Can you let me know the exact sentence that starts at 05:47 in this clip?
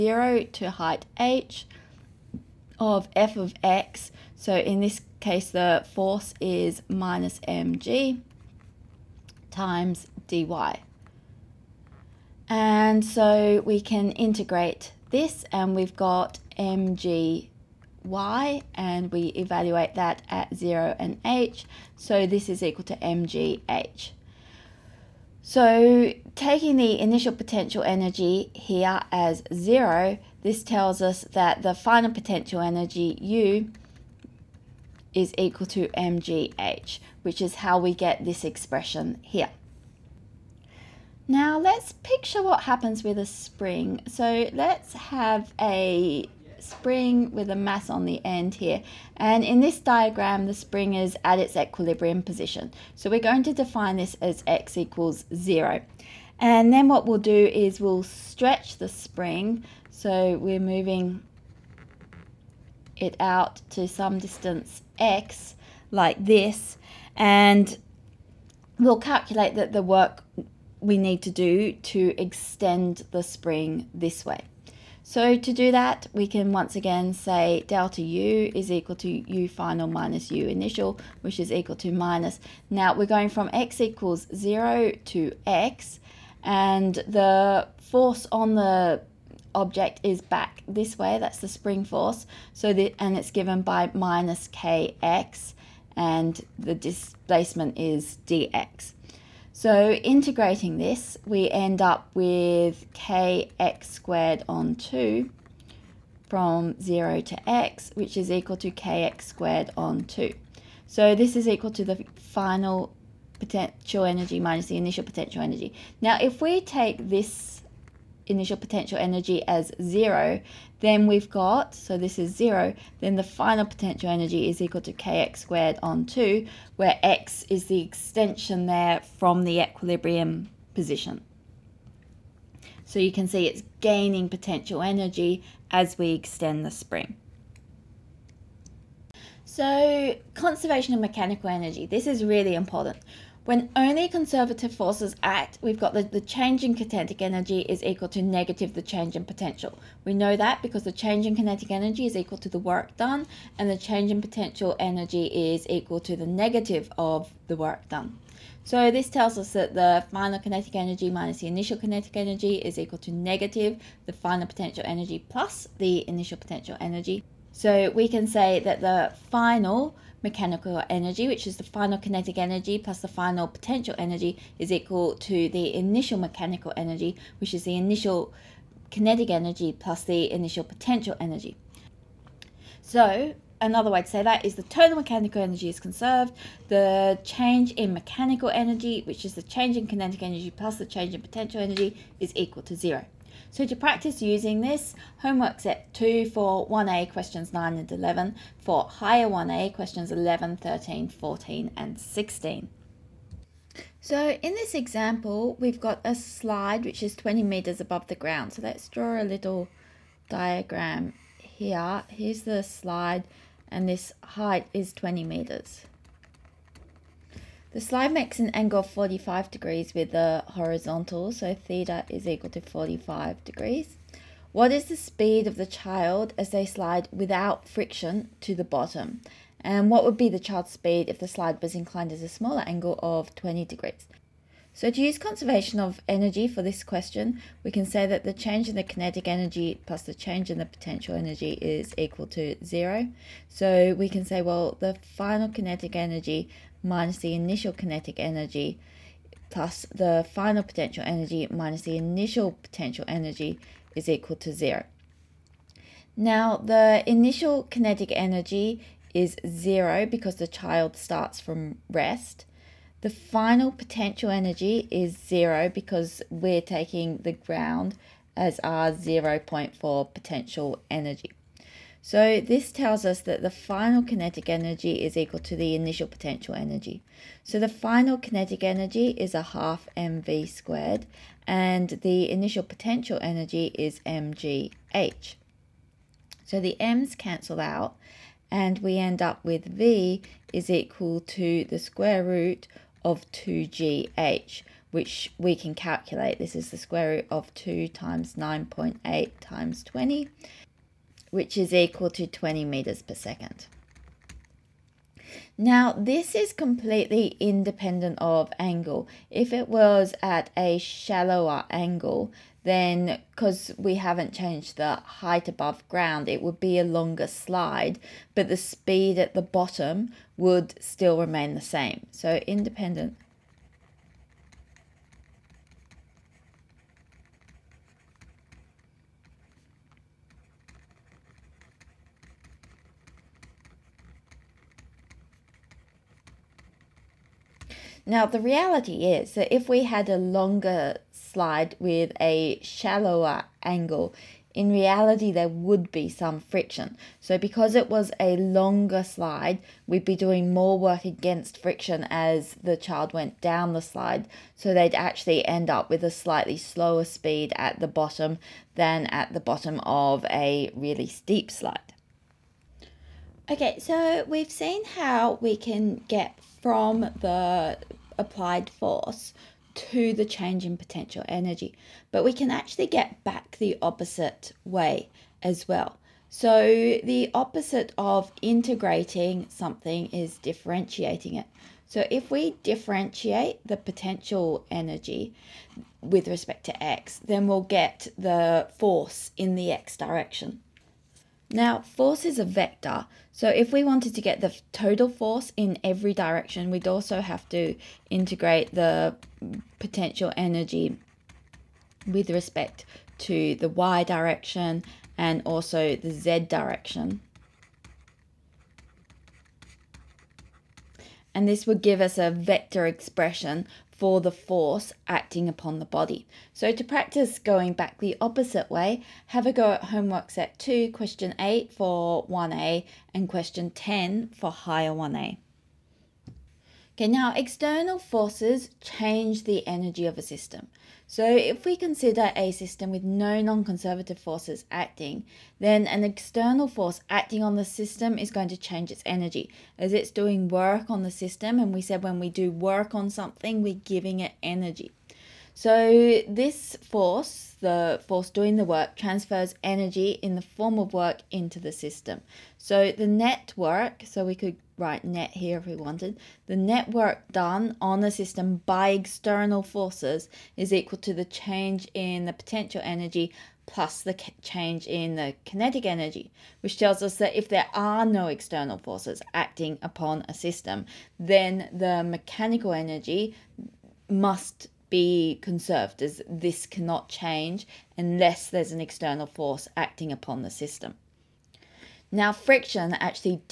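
So because it was a longer slide, we'd be doing more work against friction as the child went down the slide.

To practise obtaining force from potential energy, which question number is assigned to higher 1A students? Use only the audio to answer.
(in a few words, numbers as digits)
Question 10.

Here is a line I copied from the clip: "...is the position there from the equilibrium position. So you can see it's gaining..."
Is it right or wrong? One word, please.
wrong.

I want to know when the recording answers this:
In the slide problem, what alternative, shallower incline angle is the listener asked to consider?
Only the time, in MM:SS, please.
03:53.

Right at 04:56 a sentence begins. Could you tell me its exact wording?
This is the square root of 2 times 9.8 times 20, which is equal to 20 meters per second.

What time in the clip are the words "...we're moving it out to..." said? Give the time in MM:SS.
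01:00.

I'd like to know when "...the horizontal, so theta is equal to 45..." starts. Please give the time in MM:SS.
03:40.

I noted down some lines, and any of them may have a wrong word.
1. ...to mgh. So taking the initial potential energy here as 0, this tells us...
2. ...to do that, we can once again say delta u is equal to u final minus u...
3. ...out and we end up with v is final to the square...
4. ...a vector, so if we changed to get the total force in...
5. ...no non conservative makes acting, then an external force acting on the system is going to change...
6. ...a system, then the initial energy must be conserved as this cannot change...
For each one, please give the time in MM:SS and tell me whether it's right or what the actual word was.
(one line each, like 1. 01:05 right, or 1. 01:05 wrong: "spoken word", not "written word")
1. 00:22 right
2. 01:15 right
3. 04:47 wrong: "equal", not "final"
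4. 06:32 wrong: "wanted", not "changed"
5. 07:13 wrong: "forces", not "makes"
6. 07:50 wrong: "mechanical", not "initial".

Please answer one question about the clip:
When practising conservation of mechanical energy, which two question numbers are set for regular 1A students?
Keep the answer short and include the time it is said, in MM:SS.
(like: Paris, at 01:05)
9 and 11, at 03:17.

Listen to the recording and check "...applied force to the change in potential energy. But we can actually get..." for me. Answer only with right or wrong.
right.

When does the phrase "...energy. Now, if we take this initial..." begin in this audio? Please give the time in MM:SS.
01:55.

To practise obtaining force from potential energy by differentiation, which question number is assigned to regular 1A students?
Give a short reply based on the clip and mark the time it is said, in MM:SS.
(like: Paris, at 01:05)
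Question 8, at 07:00.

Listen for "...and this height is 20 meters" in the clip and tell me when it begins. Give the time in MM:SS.
03:33.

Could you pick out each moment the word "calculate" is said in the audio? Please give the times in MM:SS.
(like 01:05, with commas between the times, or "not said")
01:08, 04:55.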